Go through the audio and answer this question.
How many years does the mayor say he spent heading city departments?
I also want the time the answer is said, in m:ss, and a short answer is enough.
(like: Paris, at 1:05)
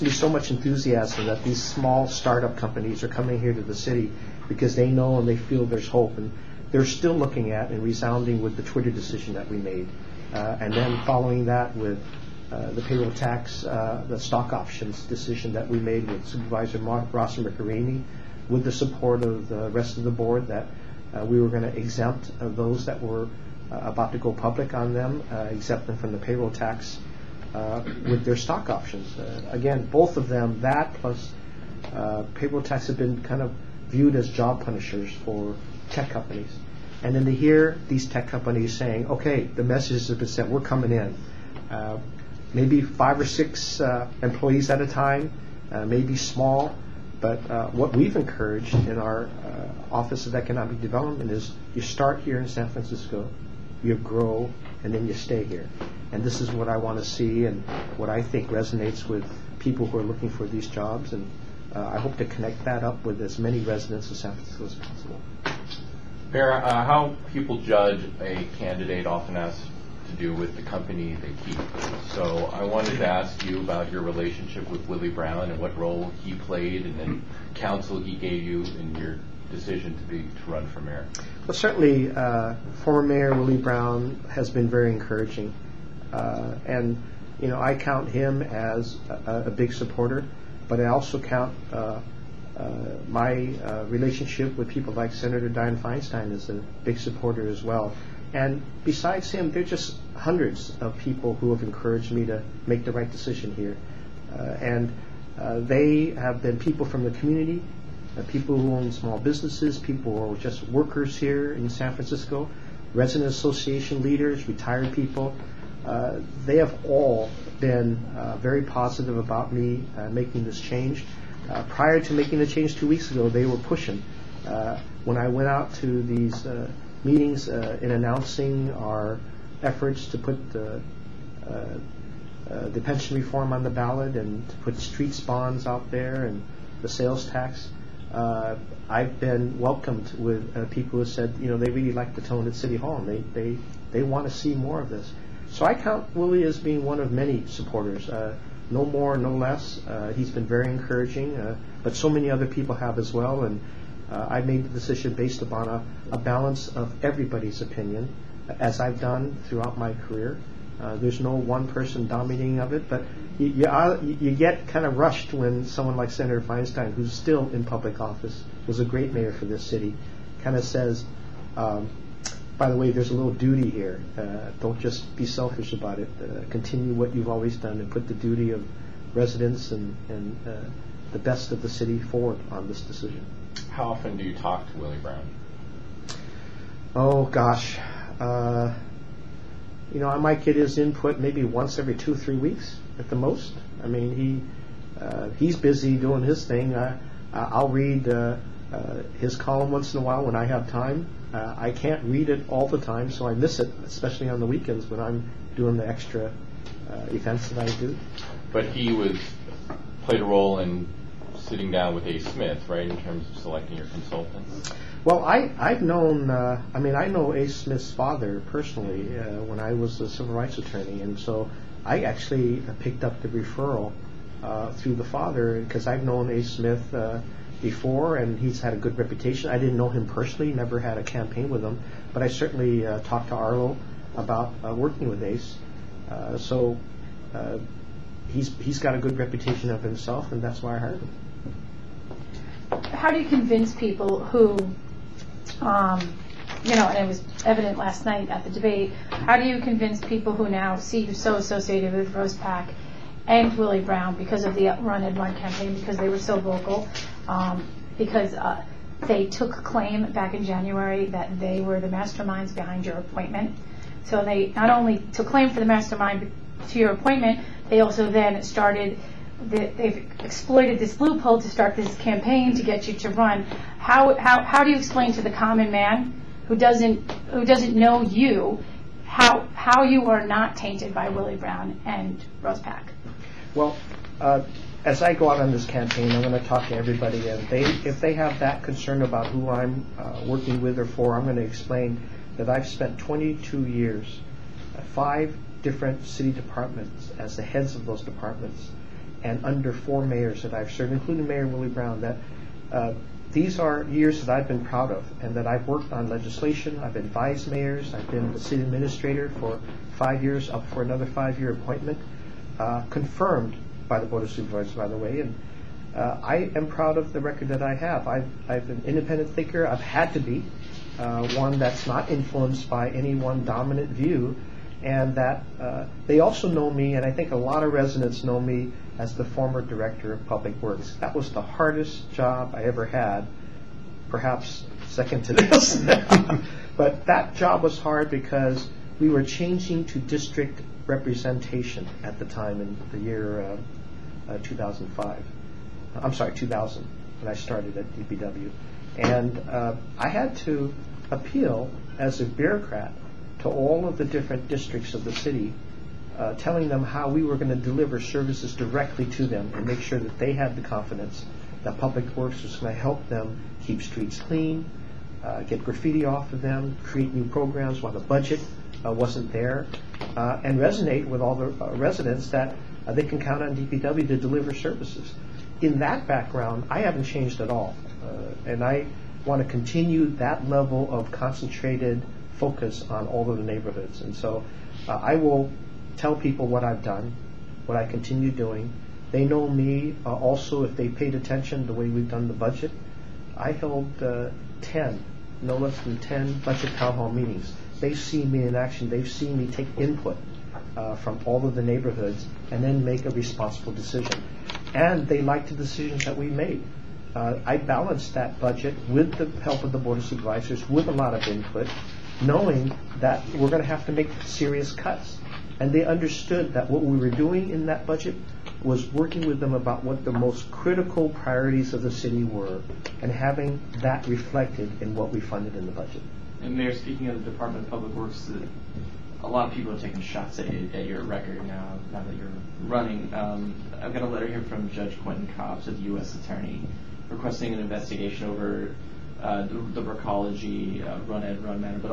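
22, at 4:52.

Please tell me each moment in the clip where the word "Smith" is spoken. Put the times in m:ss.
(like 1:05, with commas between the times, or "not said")
3:32, 3:37, 3:46.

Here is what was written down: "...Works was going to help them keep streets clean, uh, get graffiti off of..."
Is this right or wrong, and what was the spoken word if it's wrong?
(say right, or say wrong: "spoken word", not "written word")
right.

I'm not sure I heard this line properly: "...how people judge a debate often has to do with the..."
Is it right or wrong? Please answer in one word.
wrong.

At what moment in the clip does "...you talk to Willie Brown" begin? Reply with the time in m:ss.
3:04.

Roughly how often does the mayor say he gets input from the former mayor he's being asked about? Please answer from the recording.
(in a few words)
Once every 2-3 weeks.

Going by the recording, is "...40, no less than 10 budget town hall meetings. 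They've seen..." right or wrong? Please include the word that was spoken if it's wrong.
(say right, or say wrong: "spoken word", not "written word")
wrong: "10", not "40".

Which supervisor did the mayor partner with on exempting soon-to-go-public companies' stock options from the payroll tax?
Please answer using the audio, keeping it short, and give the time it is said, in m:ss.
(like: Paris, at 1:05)
Ross Mirkarimi, at 0:16.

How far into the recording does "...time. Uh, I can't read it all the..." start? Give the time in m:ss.
3:20.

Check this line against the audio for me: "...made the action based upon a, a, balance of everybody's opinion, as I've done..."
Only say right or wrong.
wrong.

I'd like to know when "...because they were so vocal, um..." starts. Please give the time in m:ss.
4:15.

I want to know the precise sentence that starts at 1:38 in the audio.
And besides him, there are just hundreds of people who have encouraged me to make the right decision here.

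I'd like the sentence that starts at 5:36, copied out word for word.
but that job was hard because we were changing to district representation at the time in the year uh, uh 2005.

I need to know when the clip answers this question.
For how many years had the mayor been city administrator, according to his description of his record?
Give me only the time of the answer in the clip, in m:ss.
5:09.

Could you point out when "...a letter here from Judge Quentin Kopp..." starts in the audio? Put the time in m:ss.
7:14.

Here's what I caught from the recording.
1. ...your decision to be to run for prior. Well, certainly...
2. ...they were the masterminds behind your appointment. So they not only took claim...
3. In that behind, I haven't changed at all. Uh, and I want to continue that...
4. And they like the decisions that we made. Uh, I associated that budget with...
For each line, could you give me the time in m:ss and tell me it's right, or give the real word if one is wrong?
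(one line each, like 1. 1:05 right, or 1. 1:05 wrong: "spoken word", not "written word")
1. 1:18 wrong: "mayor", not "prior"
2. 4:21 right
3. 6:15 wrong: "background", not "behind"
4. 6:44 wrong: "balanced", not "associated".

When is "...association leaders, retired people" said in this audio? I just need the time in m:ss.
1:53.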